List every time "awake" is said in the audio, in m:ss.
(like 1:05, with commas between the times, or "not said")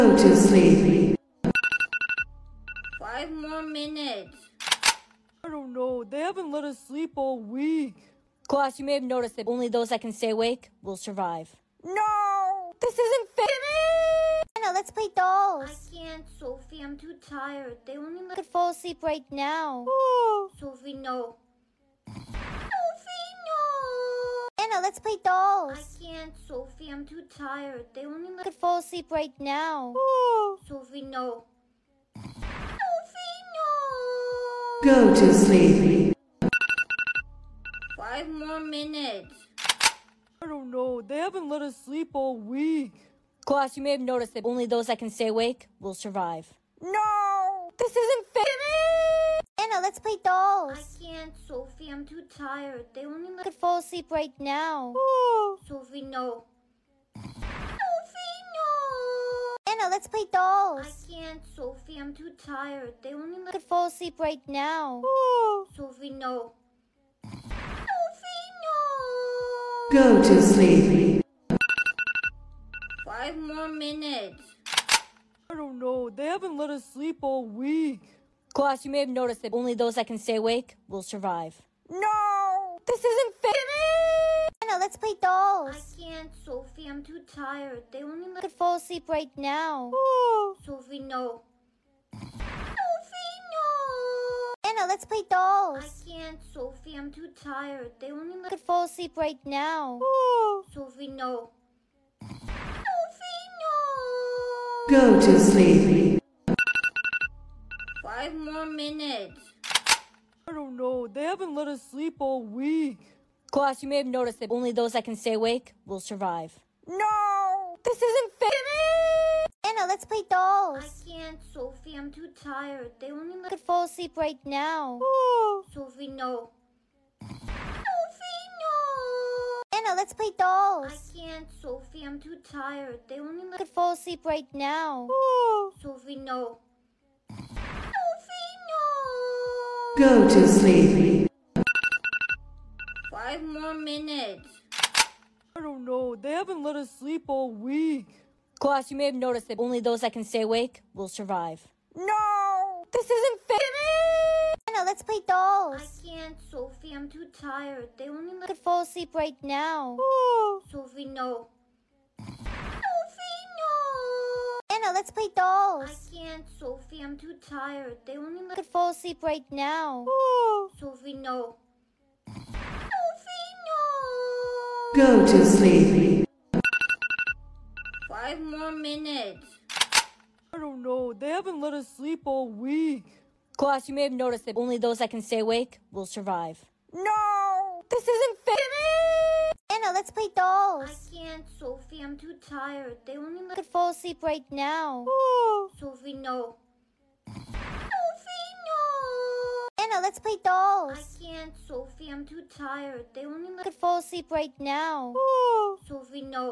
0:10, 0:45, 1:20, 1:55, 2:30, 3:05.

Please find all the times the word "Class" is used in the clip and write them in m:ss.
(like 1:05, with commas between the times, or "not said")
0:08, 0:43, 1:18, 1:53, 2:28, 3:03.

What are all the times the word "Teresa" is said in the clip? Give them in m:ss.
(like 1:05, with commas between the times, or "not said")
not said.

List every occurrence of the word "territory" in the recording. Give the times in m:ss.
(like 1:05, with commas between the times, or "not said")
not said.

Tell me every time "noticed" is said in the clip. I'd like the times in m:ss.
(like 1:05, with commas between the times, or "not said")
0:09, 0:43, 1:19, 1:54, 2:29, 3:04.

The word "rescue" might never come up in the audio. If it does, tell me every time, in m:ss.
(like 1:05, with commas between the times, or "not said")
not said.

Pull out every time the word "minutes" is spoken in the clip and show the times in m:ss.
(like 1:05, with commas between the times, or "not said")
0:03, 0:38, 1:13, 1:48, 2:23, 2:58.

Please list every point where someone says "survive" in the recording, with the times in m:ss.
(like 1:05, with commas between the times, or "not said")
0:10, 0:45, 1:21, 1:55, 2:31, 3:06.